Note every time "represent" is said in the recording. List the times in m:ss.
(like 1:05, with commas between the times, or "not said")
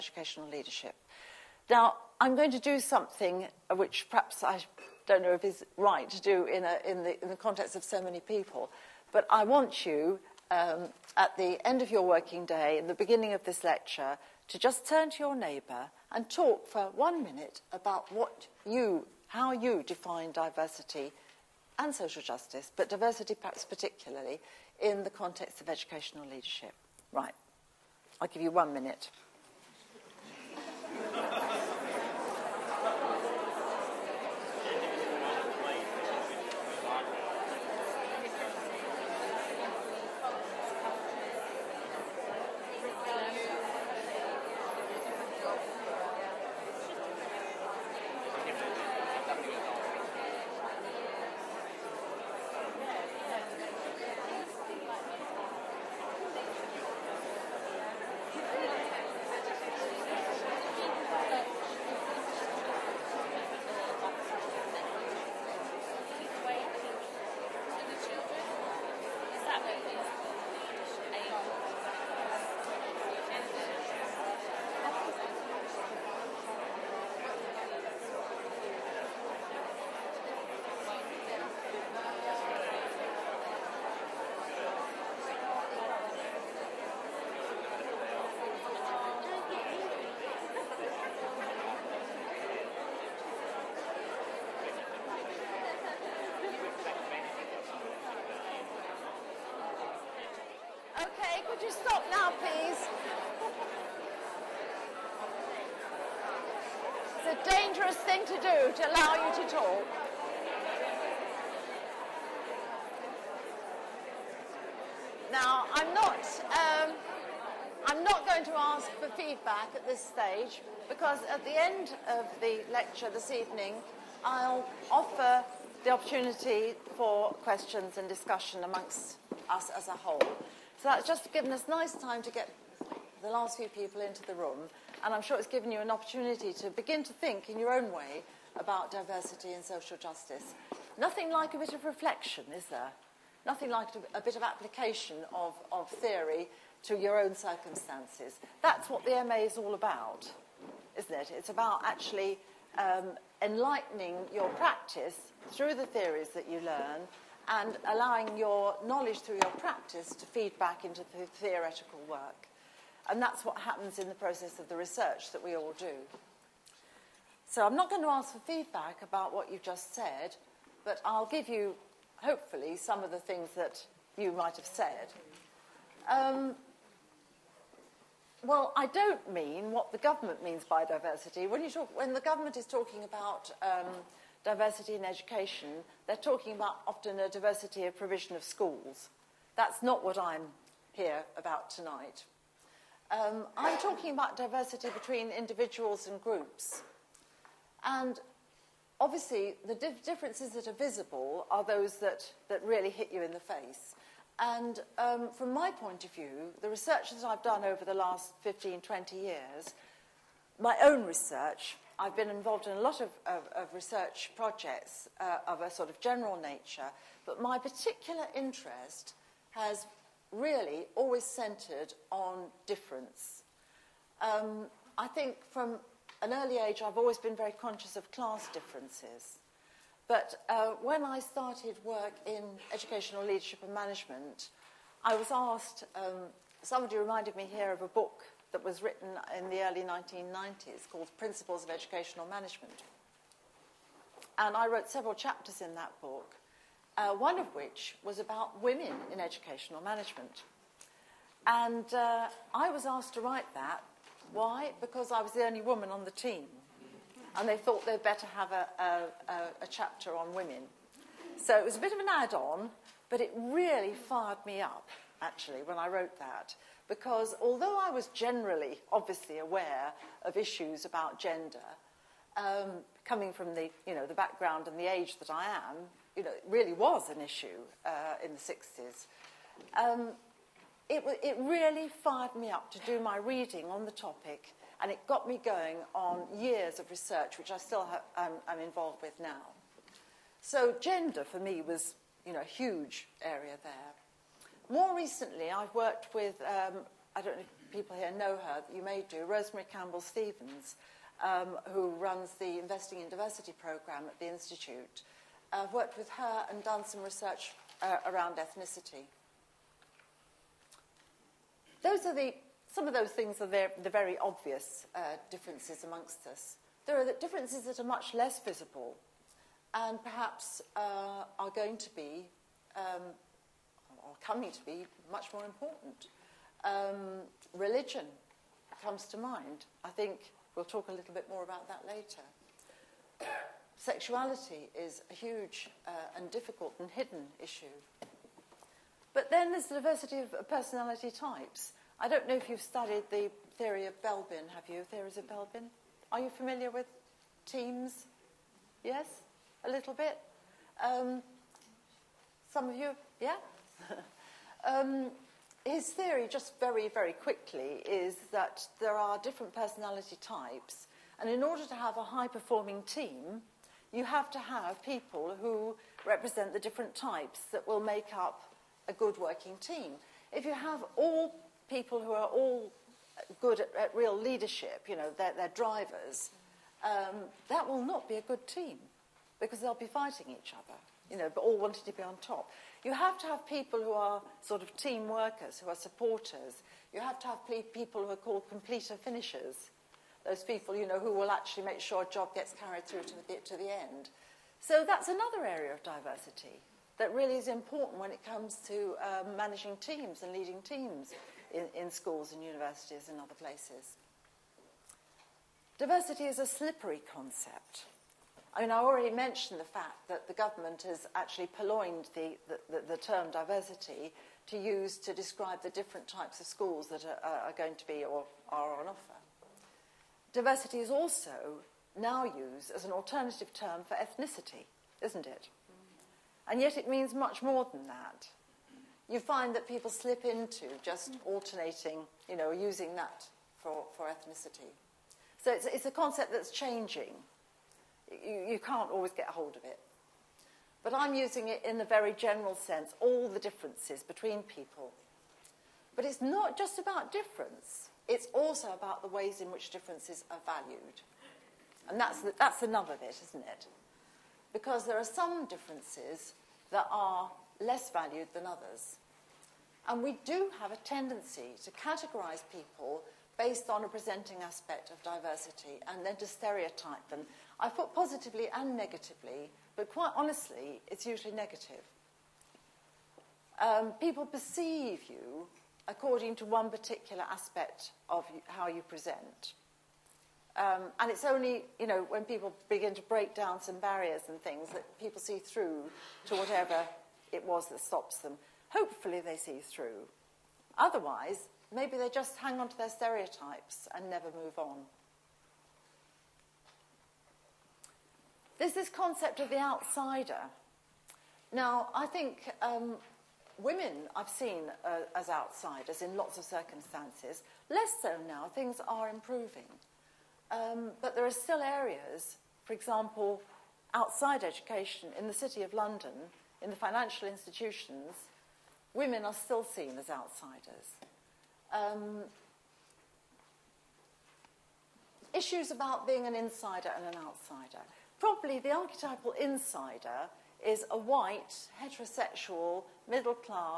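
6:06.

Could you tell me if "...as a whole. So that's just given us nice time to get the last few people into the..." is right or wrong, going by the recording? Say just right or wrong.
right.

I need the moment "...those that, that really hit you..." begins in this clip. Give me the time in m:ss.
3:21.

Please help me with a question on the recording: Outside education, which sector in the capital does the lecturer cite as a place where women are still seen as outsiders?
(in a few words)
financial institutions.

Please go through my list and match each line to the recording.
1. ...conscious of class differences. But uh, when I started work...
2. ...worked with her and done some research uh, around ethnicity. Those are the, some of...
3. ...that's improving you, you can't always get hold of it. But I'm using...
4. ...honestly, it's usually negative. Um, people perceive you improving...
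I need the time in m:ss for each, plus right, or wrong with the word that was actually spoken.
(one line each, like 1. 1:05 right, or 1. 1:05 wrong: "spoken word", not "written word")
1. 3:47 right
2. 5:05 right
3. 7:16 wrong: "changing", not "improving"
4. 7:50 wrong: "according", not "improving".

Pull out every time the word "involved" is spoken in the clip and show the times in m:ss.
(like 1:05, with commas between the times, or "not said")
3:32, 4:48.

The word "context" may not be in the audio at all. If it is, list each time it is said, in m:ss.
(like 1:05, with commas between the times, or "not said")
0:07, 0:25.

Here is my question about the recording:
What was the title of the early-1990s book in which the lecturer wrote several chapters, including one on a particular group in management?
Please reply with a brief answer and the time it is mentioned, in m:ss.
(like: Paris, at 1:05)
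Principles of Educational Management, at 4:01.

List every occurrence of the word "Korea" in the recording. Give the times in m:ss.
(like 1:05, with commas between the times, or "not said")
not said.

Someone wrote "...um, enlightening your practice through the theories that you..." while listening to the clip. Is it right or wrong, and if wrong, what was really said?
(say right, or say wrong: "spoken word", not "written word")
right.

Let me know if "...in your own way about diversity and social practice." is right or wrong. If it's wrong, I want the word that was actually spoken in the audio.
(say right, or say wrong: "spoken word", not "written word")
wrong: "justice", not "practice".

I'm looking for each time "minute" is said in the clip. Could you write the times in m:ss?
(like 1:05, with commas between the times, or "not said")
0:17, 0:28.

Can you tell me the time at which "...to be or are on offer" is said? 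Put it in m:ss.
6:57.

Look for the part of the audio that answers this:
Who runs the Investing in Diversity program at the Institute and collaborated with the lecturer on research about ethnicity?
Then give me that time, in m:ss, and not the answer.
4:59.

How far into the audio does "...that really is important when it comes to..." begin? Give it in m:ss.
6:36.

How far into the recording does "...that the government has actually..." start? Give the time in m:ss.
6:50.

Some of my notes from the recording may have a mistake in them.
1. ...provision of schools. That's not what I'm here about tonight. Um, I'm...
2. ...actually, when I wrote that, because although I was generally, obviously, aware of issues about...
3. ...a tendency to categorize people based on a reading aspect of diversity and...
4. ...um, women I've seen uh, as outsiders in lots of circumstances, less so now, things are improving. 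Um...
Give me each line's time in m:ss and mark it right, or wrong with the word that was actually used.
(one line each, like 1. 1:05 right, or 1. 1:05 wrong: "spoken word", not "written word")
1. 3:07 right
2. 4:25 right
3. 7:40 wrong: "presenting", not "reading"
4. 8:22 right.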